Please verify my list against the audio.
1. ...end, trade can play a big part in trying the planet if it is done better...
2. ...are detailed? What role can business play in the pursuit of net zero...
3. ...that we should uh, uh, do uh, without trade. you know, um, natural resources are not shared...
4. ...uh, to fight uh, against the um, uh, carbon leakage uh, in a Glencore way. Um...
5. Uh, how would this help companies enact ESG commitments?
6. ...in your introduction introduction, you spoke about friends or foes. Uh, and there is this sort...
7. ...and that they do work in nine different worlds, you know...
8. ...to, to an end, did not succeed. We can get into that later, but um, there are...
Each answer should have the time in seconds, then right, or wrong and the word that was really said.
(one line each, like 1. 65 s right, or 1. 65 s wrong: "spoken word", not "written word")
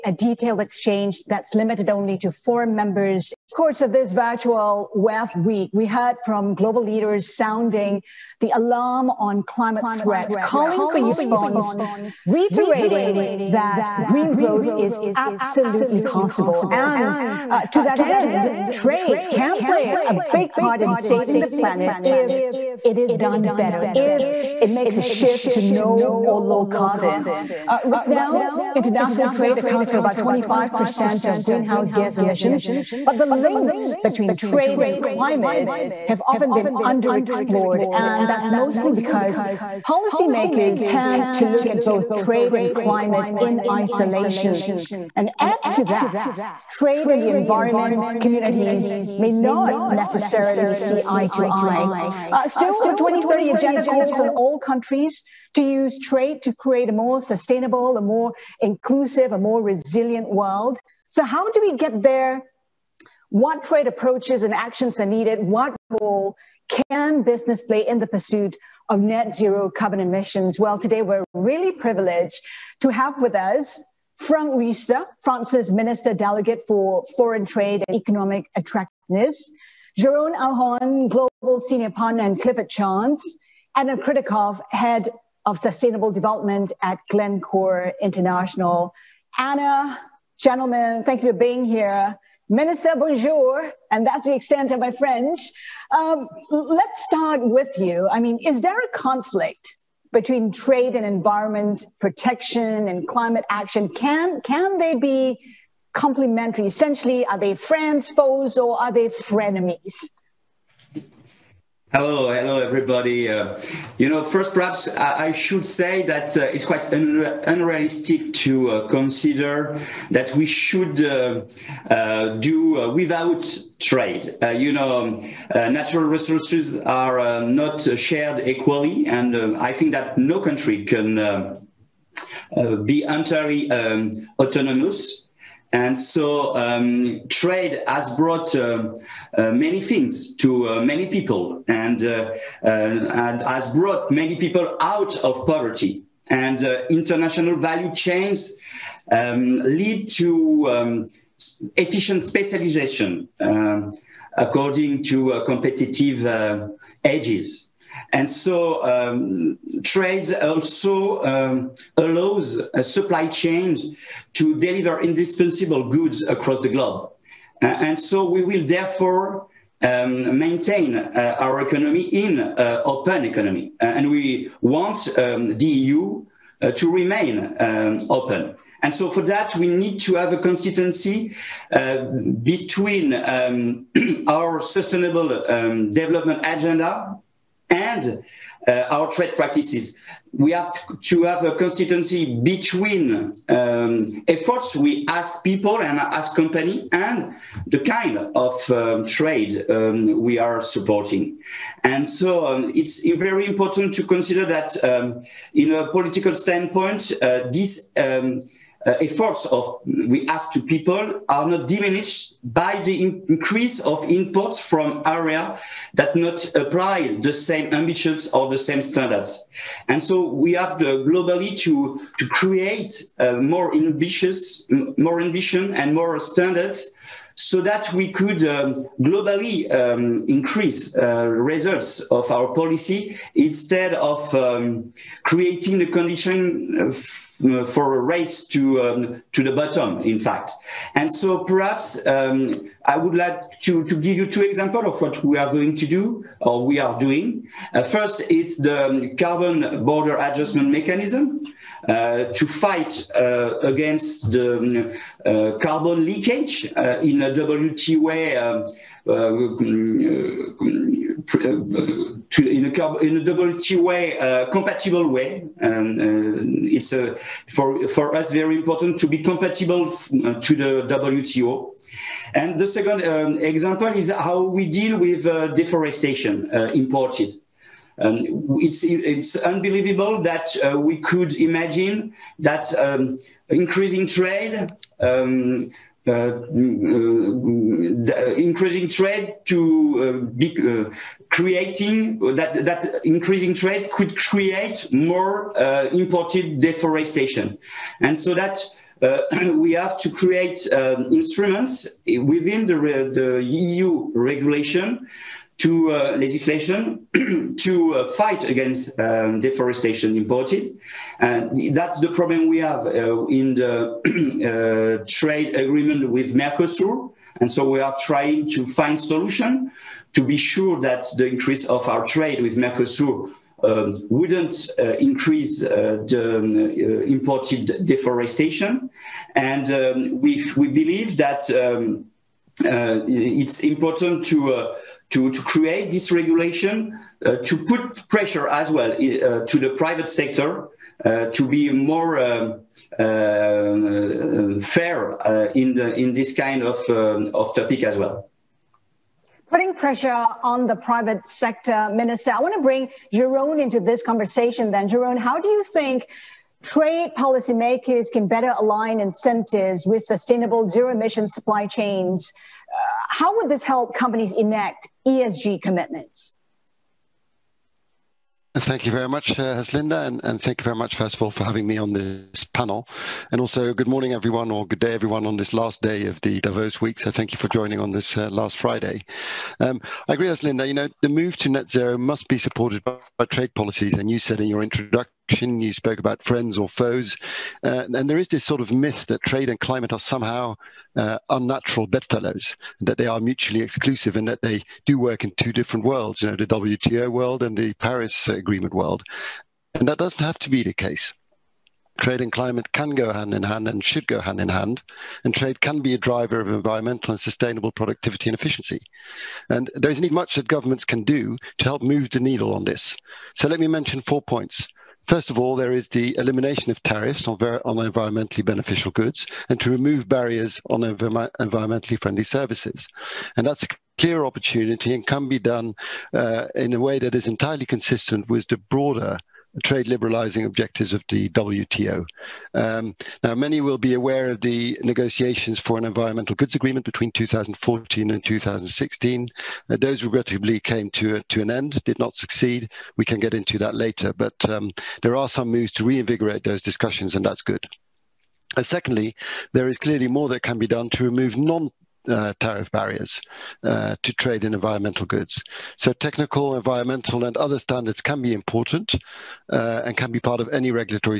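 1. 18 s wrong: "saving", not "trying"
2. 64 s wrong: "needed", not "detailed"
3. 120 s right
4. 251 s wrong: "WTO", not "Glencore"
5. 362 s right
6. 384 s right
7. 394 s wrong: "two", not "nine"
8. 440 s right.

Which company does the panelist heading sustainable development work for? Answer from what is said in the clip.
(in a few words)
Glencore International.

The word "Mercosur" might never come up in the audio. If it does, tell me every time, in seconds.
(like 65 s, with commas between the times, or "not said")
316 s, 322 s.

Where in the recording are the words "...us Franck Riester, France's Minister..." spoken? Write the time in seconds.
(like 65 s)
73 s.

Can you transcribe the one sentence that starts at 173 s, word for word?
Uh, and we want um, the EU uh, to remain um, open.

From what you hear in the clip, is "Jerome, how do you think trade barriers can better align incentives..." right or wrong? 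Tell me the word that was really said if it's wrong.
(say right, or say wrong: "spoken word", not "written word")
wrong: "policymakers", not "barriers".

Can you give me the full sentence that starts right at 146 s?
And uh, international value chains um, lead to um, efficient specialization um, according to competitive edges.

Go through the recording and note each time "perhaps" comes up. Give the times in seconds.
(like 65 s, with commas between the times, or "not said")
114 s, 241 s.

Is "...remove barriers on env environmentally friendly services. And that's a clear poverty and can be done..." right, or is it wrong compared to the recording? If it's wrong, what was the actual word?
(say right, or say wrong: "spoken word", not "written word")
wrong: "opportunity", not "poverty".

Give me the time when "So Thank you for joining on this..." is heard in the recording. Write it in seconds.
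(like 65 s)
376 s.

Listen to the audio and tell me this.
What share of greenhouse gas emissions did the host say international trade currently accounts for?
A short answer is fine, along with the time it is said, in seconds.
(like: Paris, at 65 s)
25%, at 30 s.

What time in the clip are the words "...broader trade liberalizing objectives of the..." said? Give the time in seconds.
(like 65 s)
428 s.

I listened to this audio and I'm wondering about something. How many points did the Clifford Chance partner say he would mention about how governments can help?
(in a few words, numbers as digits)
4.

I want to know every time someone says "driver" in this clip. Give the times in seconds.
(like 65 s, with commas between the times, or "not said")
405 s.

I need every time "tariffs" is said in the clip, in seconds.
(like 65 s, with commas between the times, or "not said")
416 s, 452 s.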